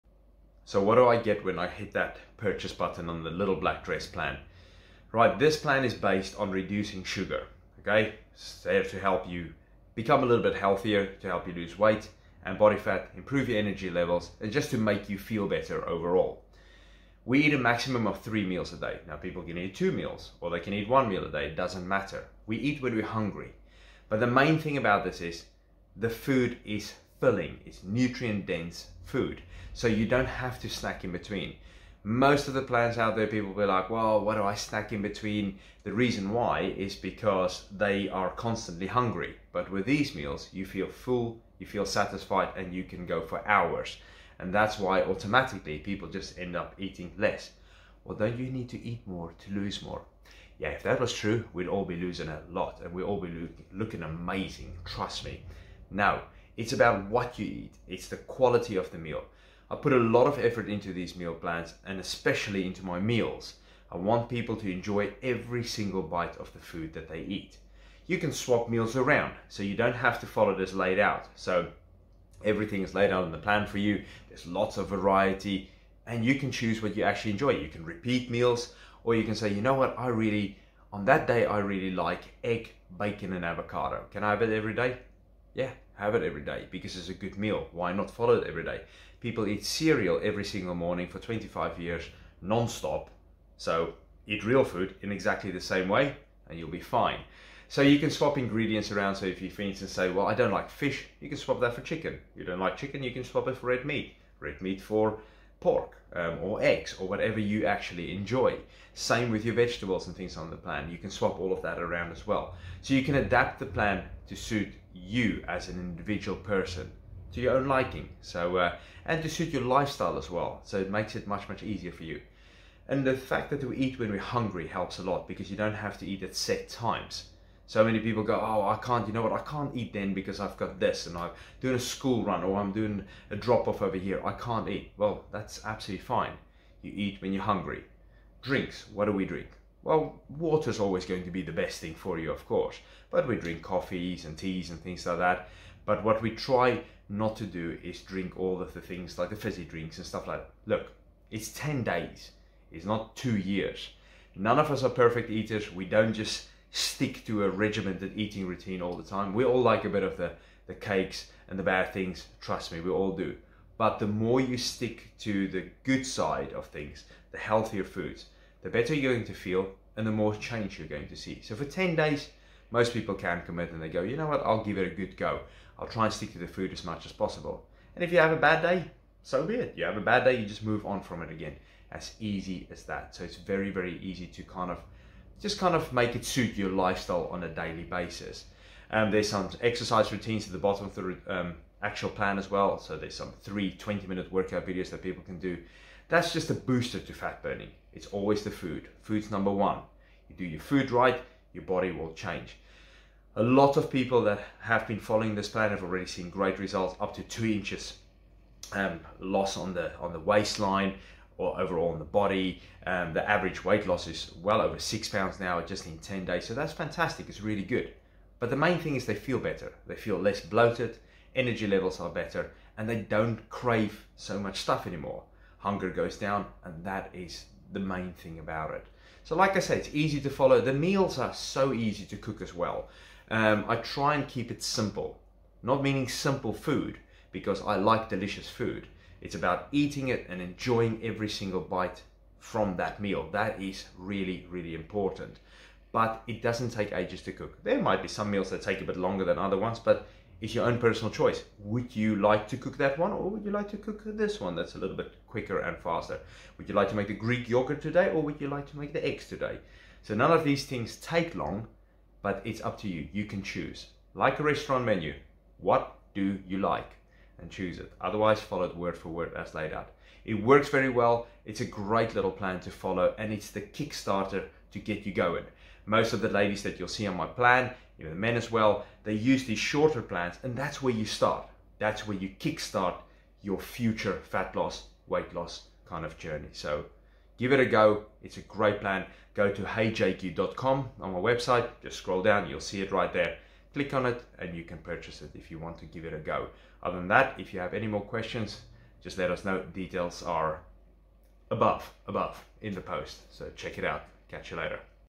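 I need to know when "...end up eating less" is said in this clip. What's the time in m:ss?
0:46.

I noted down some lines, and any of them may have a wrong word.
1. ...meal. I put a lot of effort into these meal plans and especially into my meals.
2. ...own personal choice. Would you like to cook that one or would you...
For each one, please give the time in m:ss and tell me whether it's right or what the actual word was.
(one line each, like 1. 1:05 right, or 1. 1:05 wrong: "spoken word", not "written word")
1. 0:58 right
2. 4:10 right.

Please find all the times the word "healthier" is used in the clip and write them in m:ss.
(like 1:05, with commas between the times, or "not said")
0:10, 2:47.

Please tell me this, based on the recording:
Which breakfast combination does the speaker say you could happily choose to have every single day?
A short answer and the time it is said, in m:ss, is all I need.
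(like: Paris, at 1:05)
Egg, bacon, and avocado, at 1:22.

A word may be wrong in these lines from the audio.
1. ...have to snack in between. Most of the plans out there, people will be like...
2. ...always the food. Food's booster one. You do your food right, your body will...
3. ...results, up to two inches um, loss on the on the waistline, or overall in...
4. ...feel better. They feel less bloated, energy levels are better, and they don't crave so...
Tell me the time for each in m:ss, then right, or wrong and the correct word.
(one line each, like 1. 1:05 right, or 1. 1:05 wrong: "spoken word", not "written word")
1. 0:30 right
2. 3:18 wrong: "number", not "booster"
3. 3:26 right
4. 3:39 right.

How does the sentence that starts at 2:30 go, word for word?
Look, it's 10 days, it's not two years.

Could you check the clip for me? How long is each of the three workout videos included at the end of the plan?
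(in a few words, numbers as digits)
20 minutes.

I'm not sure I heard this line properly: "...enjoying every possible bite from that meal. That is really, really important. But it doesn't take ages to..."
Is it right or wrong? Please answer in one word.
wrong.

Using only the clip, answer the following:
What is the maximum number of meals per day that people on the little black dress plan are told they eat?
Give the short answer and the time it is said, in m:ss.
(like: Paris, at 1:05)
3, at 0:18.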